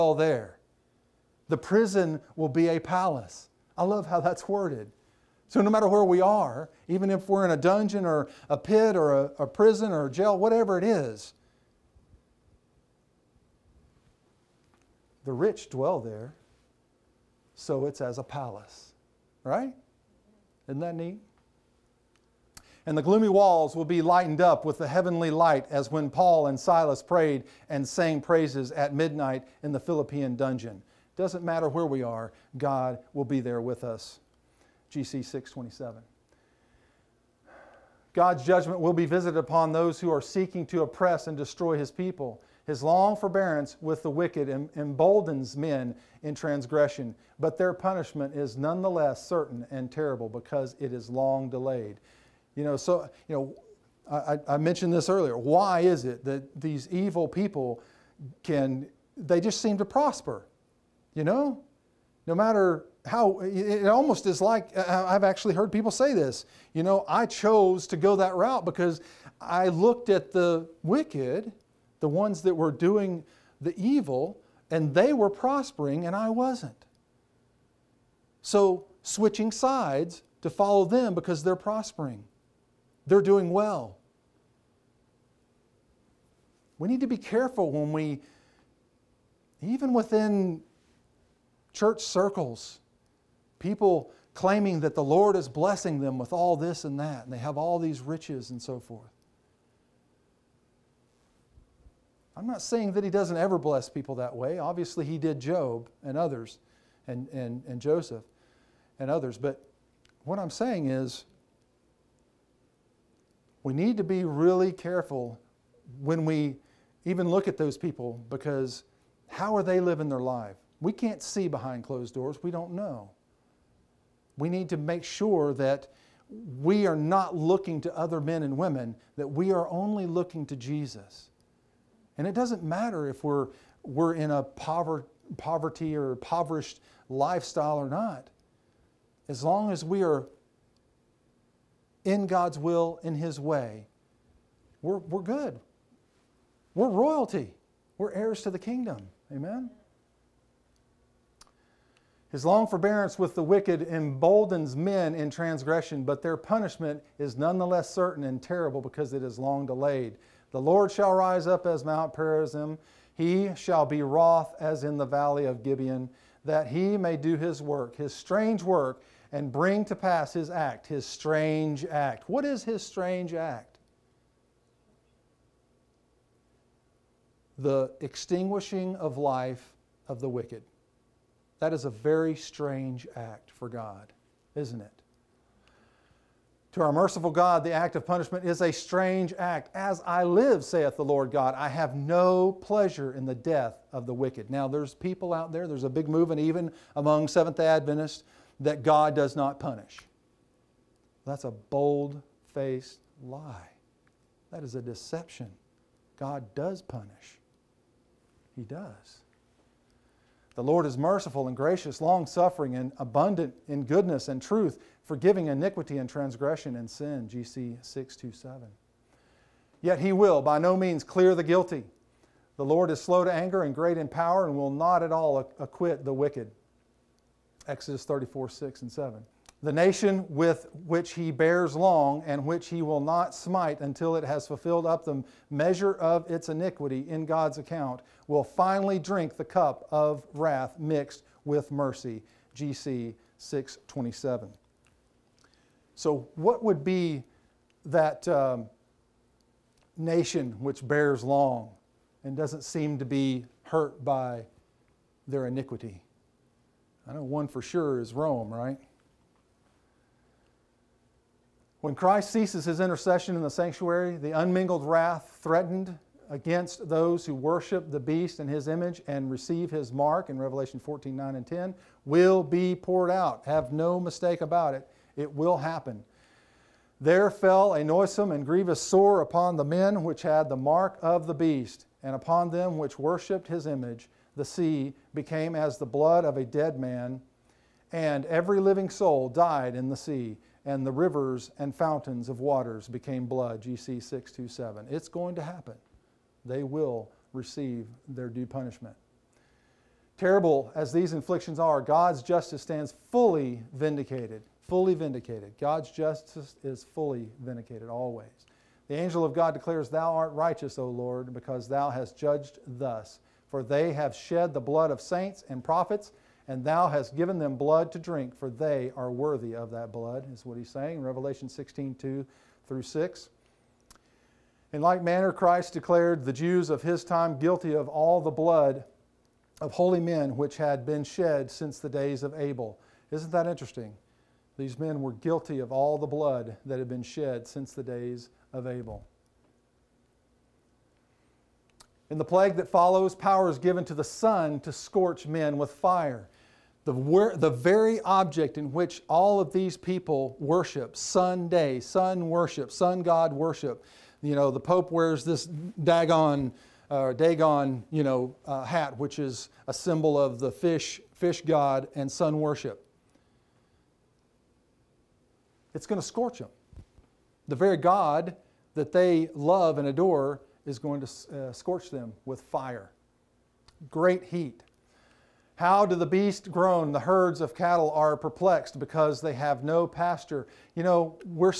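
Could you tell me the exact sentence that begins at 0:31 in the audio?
Doesn't matter where we are, God will be there with us.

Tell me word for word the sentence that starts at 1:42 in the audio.
I'm not saying that he doesn't ever bless people that way.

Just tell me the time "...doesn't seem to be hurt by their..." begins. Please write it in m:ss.
4:12.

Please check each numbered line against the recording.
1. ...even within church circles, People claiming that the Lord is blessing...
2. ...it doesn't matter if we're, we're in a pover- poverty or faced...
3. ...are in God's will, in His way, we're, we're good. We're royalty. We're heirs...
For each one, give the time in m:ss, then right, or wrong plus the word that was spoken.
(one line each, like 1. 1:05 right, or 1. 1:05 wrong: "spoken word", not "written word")
1. 1:29 right
2. 2:12 wrong: "impoverished", not "faced"
3. 2:20 right.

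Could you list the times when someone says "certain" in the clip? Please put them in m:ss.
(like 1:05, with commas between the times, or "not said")
0:49, 2:37.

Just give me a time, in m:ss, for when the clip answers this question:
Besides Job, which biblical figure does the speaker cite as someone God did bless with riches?
1:47.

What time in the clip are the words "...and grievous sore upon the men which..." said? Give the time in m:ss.
4:38.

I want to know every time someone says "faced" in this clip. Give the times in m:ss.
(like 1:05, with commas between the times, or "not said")
3:22.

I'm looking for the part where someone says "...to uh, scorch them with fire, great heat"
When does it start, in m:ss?
6:11.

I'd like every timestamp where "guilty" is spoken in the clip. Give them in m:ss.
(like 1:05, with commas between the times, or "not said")
3:41, 5:27, 5:35.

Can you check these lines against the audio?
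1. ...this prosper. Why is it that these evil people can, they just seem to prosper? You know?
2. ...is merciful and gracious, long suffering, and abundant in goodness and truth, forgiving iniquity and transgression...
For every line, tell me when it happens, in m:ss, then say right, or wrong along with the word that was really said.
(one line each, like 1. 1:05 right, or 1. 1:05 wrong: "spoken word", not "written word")
1. 0:54 wrong: "earlier", not "prosper"
2. 3:30 right.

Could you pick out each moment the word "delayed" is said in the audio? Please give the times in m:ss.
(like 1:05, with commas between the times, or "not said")
0:51, 2:39.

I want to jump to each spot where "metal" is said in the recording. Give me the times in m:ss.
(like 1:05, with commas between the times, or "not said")
not said.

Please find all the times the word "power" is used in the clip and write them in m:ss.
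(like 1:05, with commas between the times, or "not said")
3:44, 5:43.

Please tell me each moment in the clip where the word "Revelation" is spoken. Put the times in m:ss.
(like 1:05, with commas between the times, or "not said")
4:30, 5:21.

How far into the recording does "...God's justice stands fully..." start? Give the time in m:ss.
5:01.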